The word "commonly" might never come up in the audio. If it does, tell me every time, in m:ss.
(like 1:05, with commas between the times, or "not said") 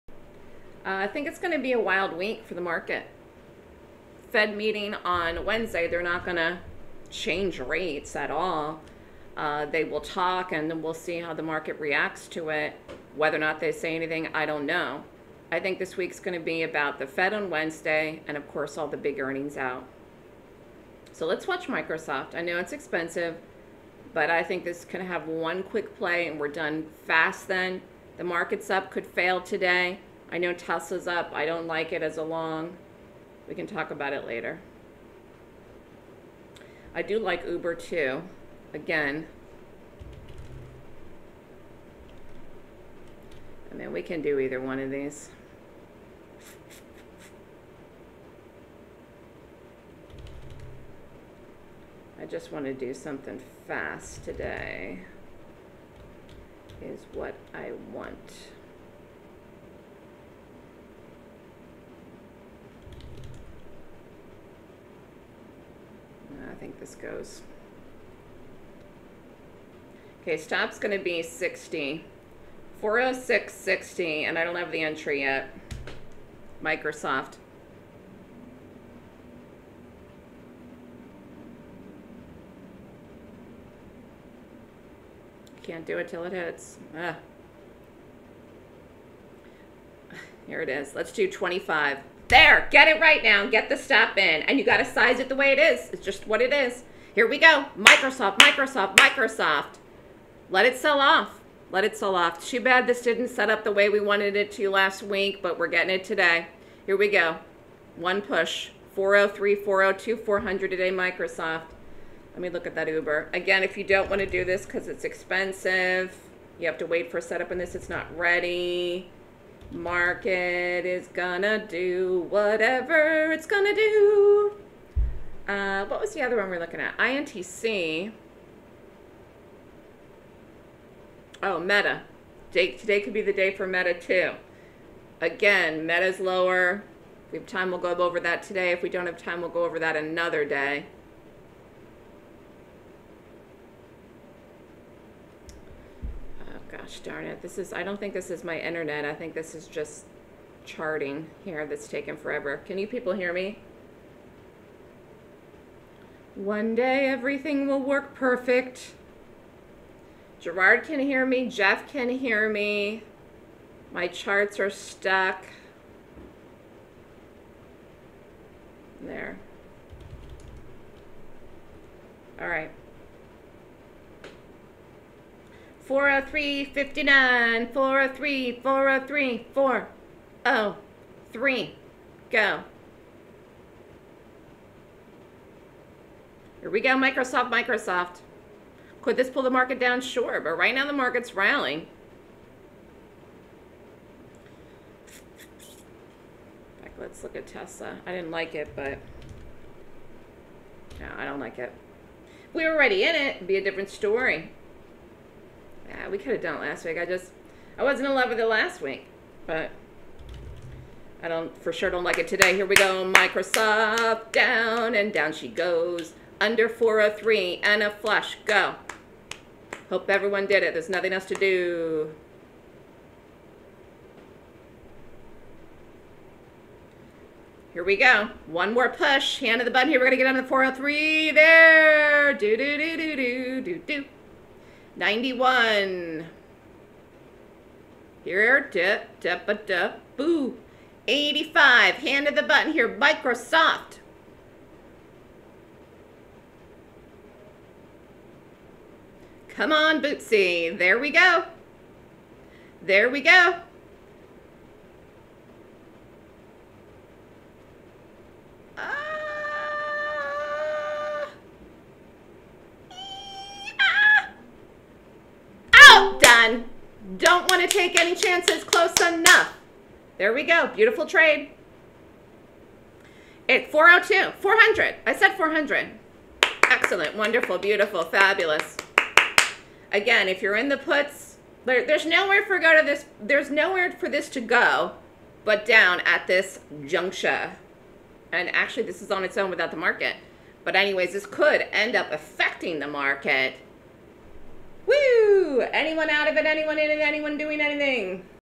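not said.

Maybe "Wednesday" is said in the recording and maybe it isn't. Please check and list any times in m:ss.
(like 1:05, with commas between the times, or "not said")
0:05, 0:17.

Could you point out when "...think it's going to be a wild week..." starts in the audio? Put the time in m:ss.
0:01.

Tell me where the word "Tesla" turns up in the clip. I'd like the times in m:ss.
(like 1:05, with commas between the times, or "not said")
0:30, 3:17.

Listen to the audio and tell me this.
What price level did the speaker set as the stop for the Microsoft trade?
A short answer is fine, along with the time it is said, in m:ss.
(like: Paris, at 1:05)
406.60, at 1:12.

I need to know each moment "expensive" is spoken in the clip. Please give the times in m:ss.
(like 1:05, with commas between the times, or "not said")
0:22, 1:55.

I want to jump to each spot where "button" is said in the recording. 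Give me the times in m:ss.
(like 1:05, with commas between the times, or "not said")
3:49, 4:02.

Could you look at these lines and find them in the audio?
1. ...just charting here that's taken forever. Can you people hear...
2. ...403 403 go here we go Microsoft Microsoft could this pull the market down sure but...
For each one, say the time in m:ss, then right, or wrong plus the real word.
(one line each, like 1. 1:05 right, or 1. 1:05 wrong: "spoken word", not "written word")
1. 2:29 right
2. 2:58 right.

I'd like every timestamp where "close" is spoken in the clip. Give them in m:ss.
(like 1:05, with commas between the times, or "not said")
4:28.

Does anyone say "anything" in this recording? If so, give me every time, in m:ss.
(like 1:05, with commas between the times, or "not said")
0:13, 4:57.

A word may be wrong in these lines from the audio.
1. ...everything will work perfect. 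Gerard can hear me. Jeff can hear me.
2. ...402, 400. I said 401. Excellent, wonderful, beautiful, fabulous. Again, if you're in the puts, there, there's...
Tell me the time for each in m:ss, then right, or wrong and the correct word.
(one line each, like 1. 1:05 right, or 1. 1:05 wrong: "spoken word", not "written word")
1. 2:37 right
2. 4:33 wrong: "400", not "401".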